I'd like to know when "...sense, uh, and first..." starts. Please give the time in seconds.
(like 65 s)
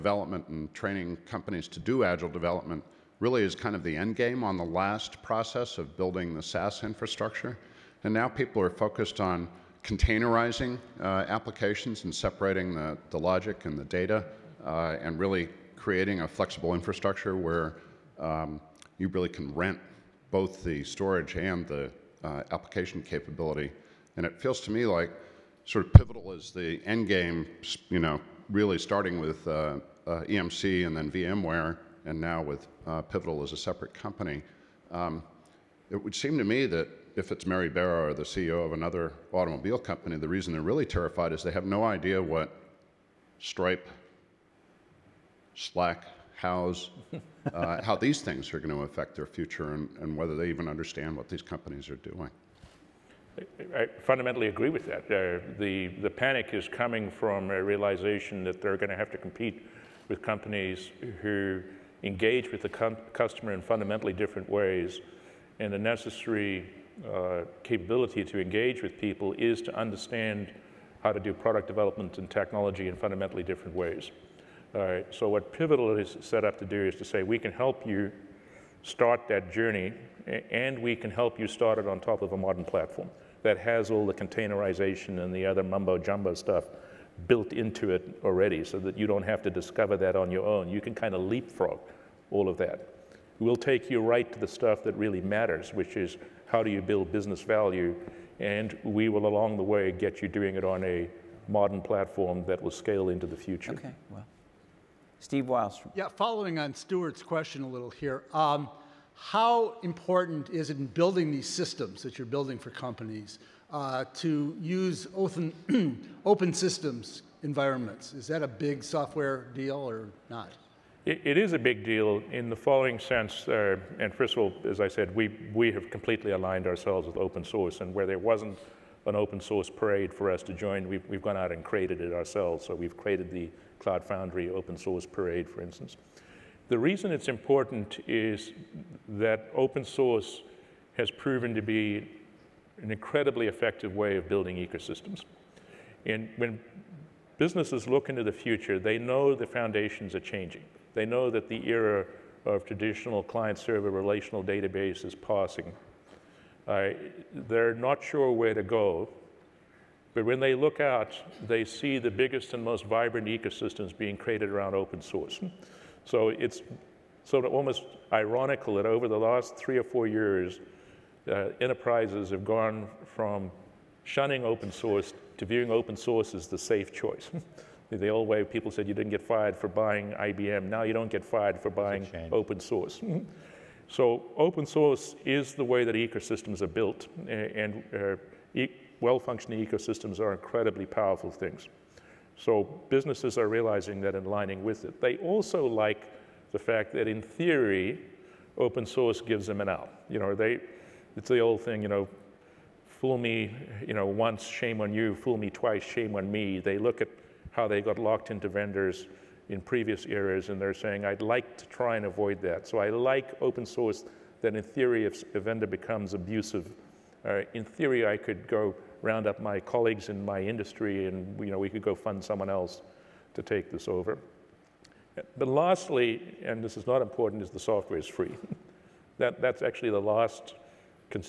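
122 s.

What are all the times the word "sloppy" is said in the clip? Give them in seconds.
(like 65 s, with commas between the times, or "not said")
not said.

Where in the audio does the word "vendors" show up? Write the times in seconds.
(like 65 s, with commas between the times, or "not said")
208 s, 215 s.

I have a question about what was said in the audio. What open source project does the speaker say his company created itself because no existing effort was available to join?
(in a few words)
Cloud Foundry.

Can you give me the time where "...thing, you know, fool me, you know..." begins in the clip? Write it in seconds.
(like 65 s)
201 s.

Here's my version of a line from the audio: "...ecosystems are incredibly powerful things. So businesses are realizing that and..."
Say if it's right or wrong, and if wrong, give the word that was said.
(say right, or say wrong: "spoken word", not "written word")
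right.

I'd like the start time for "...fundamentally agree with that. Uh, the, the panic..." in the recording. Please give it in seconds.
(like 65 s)
54 s.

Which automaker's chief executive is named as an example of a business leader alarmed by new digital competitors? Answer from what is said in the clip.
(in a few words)
Mary Barra.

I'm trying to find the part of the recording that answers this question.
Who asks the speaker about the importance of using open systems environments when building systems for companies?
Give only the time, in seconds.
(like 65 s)
105 s.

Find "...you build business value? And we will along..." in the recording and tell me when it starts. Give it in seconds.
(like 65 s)
96 s.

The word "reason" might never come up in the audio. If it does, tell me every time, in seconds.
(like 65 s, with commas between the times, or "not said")
40 s, 136 s.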